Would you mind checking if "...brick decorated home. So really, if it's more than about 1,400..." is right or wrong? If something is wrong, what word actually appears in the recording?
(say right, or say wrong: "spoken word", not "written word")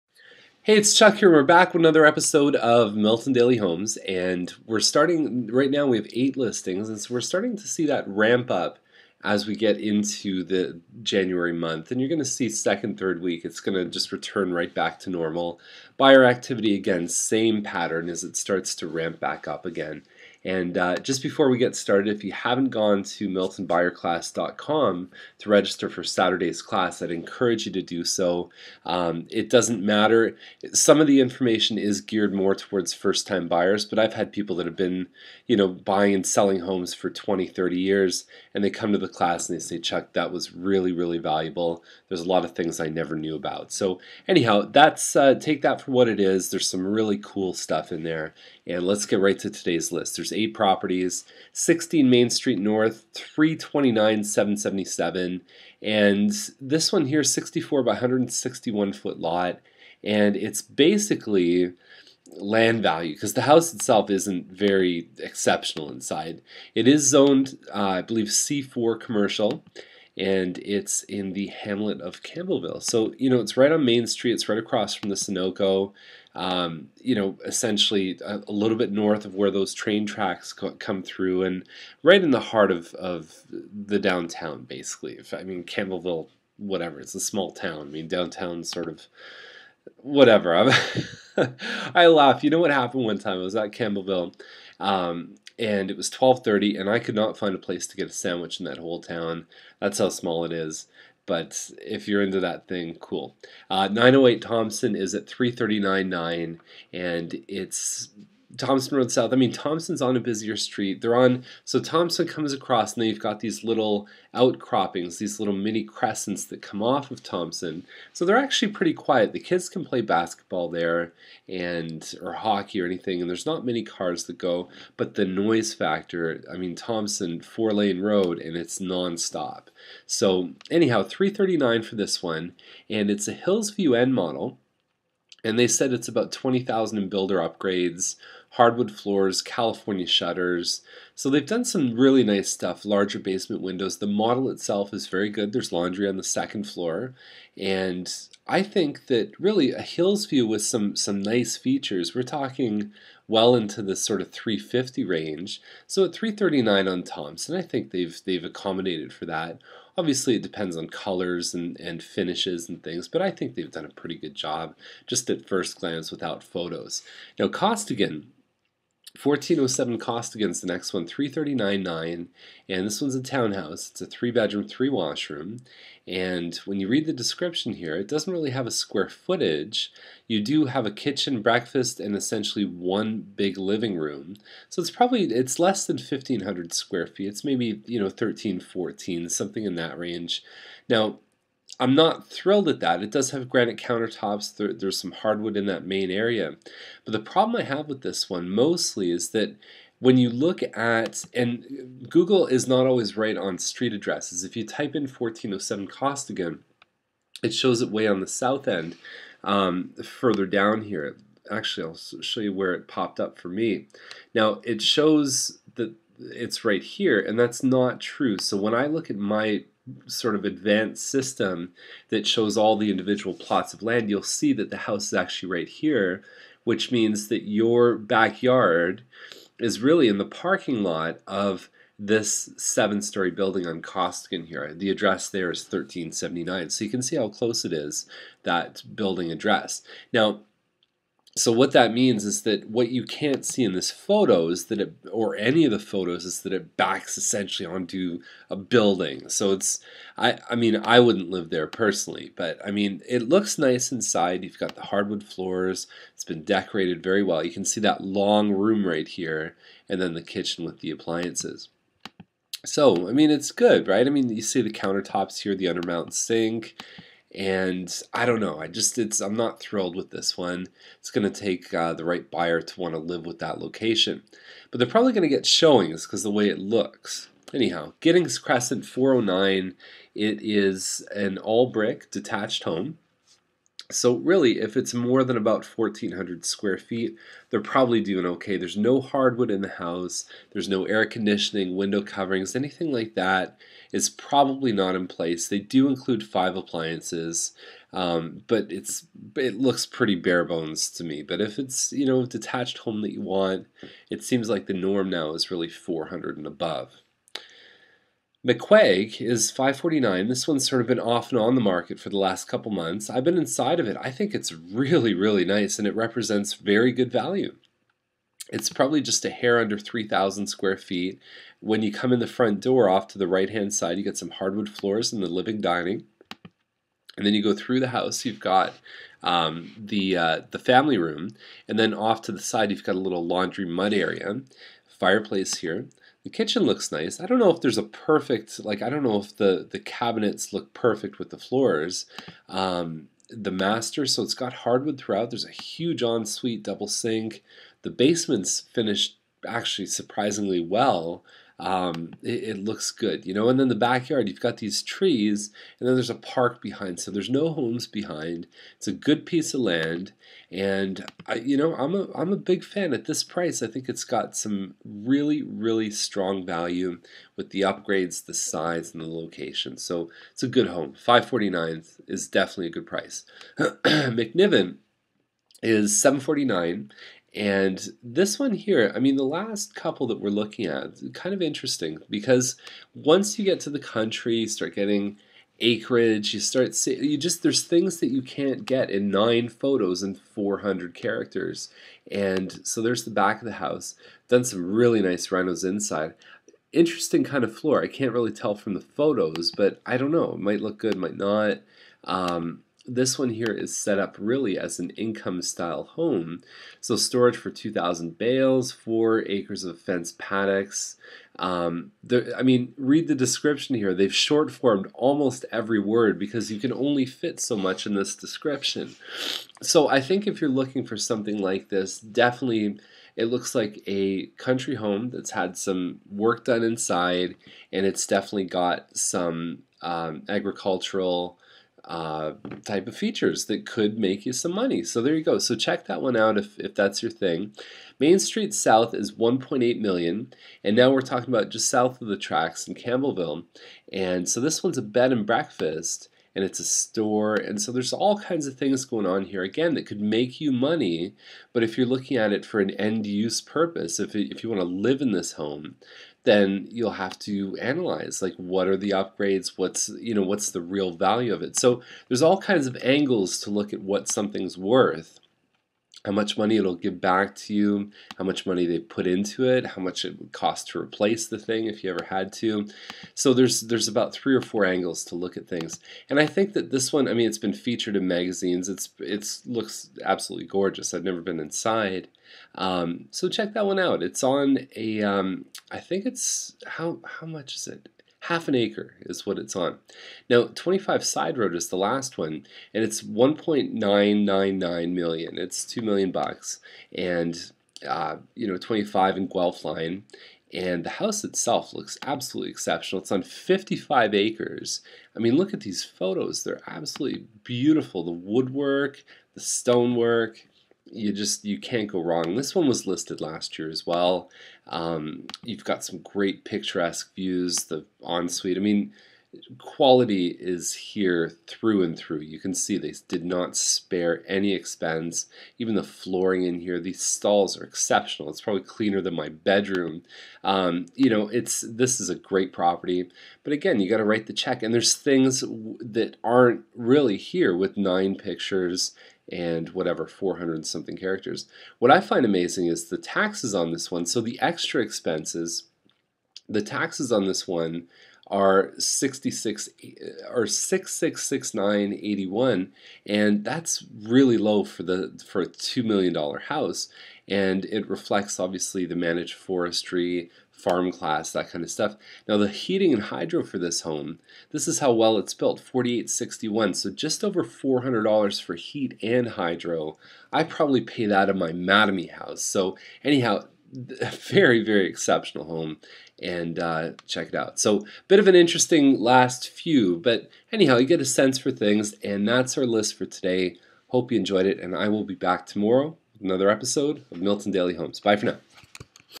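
wrong: "detached", not "decorated".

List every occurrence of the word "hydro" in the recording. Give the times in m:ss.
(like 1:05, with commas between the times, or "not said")
9:23, 9:29.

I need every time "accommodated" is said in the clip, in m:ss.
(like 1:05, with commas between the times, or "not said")
2:38.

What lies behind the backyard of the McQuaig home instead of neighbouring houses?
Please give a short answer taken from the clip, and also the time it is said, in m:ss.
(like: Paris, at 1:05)
a park, at 5:55.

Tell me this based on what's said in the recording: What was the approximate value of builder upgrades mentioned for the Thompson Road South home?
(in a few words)
20,000.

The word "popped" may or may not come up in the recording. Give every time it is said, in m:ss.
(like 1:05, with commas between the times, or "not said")
3:32.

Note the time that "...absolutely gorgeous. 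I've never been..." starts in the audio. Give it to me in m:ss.
8:00.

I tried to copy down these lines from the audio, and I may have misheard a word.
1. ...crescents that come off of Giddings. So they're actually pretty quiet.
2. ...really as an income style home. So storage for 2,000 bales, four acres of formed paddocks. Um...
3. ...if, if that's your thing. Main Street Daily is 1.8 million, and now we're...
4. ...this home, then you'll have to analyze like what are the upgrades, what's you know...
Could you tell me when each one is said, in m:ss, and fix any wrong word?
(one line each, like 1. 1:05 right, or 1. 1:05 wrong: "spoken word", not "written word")
1. 1:55 wrong: "Thompson", not "Giddings"
2. 6:44 wrong: "fenced", not "formed"
3. 7:16 wrong: "South", not "Daily"
4. 7:35 right.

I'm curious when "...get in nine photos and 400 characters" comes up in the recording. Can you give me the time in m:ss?
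6:28.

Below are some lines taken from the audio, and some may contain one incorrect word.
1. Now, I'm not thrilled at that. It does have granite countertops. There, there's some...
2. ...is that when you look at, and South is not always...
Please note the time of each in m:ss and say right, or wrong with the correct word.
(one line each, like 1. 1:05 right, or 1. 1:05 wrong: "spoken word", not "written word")
1. 3:10 right
2. 3:19 wrong: "Google", not "South".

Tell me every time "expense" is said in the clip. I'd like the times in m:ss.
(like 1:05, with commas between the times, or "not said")
8:44, 9:04.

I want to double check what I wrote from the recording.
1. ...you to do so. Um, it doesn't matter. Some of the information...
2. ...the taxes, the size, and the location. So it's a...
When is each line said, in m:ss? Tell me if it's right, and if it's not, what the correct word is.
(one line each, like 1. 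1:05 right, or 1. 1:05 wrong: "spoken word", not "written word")
1. 0:27 right
2. 6:07 wrong: "upgrades", not "taxes".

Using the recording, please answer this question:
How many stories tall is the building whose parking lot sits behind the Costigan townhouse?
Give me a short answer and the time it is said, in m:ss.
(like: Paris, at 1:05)
7, at 3:52.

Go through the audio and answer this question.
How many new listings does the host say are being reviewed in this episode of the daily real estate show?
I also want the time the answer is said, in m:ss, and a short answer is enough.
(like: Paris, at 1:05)
8, at 0:06.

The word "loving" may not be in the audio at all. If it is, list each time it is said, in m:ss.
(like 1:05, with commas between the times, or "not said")
not said.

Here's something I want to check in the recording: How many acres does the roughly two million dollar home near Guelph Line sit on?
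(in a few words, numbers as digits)
55.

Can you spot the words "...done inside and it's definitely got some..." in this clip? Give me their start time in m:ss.
7:06.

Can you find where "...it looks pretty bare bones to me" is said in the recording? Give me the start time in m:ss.
4:59.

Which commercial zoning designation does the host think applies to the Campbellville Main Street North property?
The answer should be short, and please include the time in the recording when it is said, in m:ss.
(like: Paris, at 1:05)
C4 commercial, at 1:08.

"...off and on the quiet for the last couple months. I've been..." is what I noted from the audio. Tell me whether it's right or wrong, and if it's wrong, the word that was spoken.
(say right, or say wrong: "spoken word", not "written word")
wrong: "market", not "quiet".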